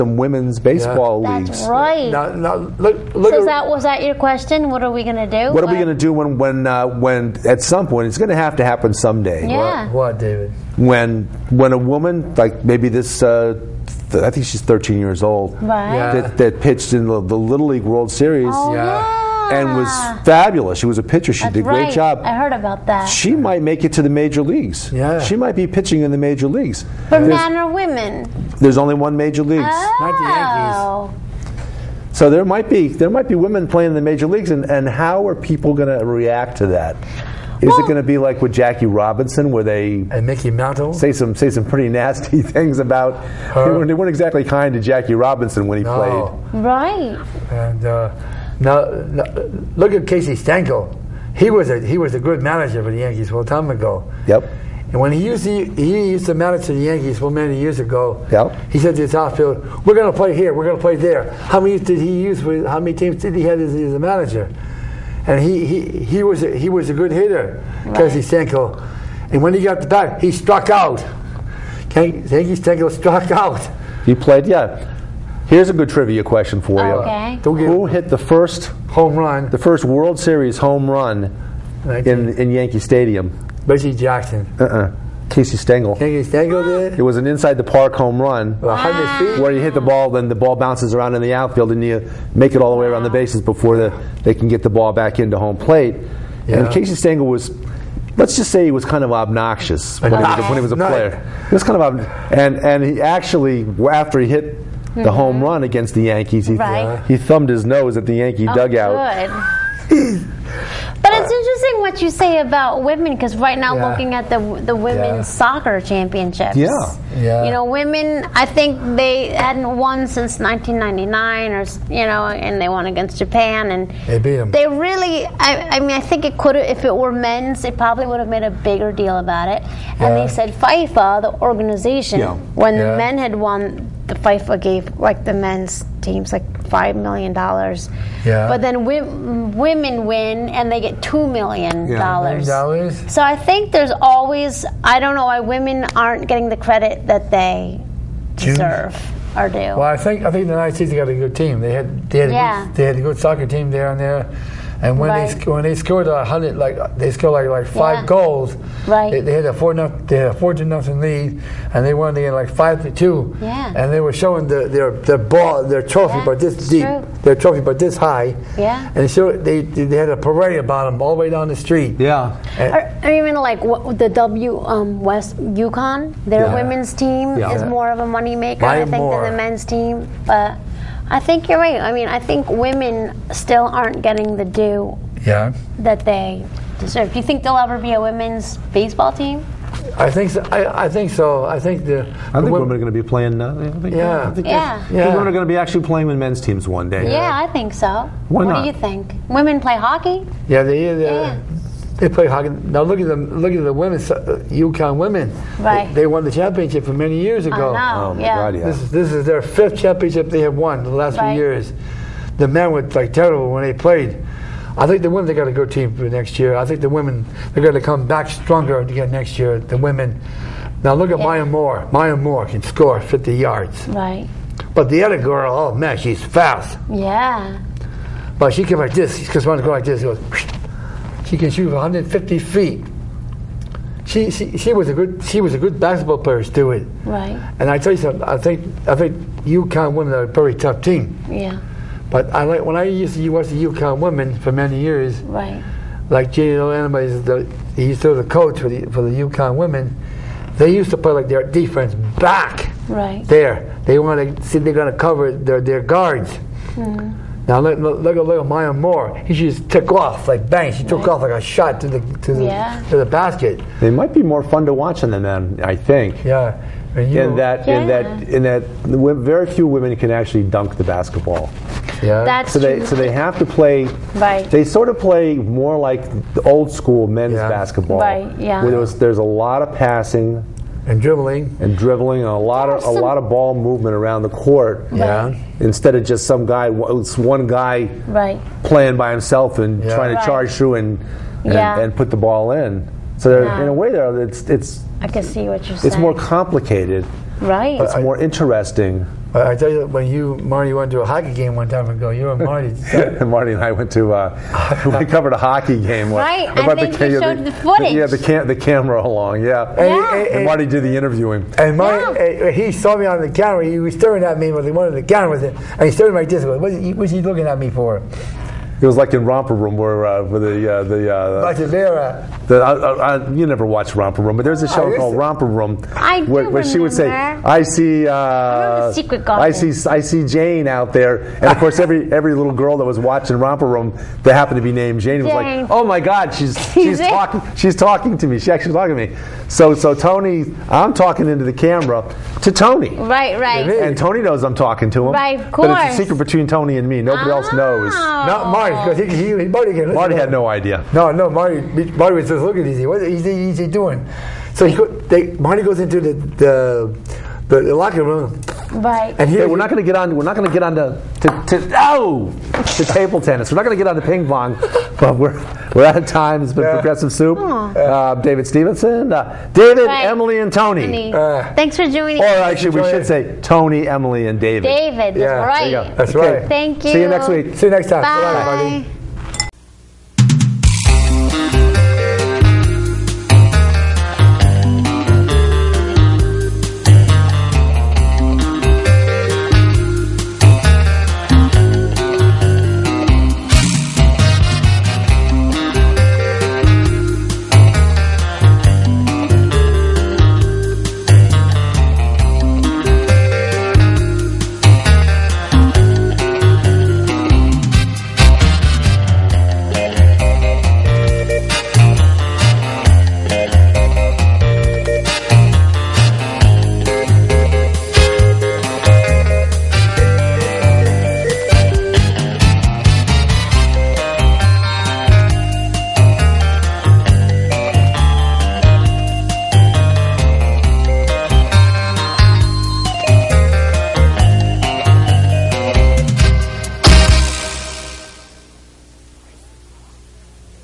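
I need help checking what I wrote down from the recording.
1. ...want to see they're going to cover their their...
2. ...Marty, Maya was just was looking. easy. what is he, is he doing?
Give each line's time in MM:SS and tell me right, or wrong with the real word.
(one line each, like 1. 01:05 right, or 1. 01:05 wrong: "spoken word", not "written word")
1. 04:13 right
2. 05:51 wrong: "Marty", not "Maya".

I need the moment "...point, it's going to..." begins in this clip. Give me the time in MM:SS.
00:07.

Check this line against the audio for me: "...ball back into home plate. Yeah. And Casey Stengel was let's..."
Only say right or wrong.
right.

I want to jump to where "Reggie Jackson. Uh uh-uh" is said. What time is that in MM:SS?
01:23.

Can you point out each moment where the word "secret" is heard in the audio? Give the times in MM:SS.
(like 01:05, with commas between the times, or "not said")
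05:28, 05:46.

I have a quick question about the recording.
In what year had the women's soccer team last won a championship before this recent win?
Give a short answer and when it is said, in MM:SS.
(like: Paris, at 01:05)
1999, at 02:00.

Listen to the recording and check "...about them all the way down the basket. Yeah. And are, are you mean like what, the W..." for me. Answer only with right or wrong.
wrong.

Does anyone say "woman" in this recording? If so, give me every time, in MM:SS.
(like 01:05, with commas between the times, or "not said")
00:11.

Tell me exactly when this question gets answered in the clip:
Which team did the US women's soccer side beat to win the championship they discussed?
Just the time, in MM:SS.
02:03.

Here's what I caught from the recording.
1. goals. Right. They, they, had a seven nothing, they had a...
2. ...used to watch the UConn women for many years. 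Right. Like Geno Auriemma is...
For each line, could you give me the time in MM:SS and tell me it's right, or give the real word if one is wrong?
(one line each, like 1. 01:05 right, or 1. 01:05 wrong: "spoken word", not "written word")
1. 02:38 wrong: "four", not "seven"
2. 04:02 right.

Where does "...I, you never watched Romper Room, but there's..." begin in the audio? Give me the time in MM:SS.
05:23.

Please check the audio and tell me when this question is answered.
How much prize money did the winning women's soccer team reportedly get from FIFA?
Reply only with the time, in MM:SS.
02:20.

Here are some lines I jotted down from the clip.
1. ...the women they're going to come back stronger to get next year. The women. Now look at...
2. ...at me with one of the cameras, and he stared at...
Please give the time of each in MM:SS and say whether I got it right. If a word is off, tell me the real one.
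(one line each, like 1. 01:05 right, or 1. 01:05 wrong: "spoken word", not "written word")
1. 03:36 right
2. 05:14 right.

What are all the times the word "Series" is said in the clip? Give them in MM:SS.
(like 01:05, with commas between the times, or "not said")
00:18, 01:20.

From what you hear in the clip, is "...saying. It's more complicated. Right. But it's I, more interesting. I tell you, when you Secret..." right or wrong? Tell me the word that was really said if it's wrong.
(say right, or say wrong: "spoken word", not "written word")
wrong: "Marty", not "Secret".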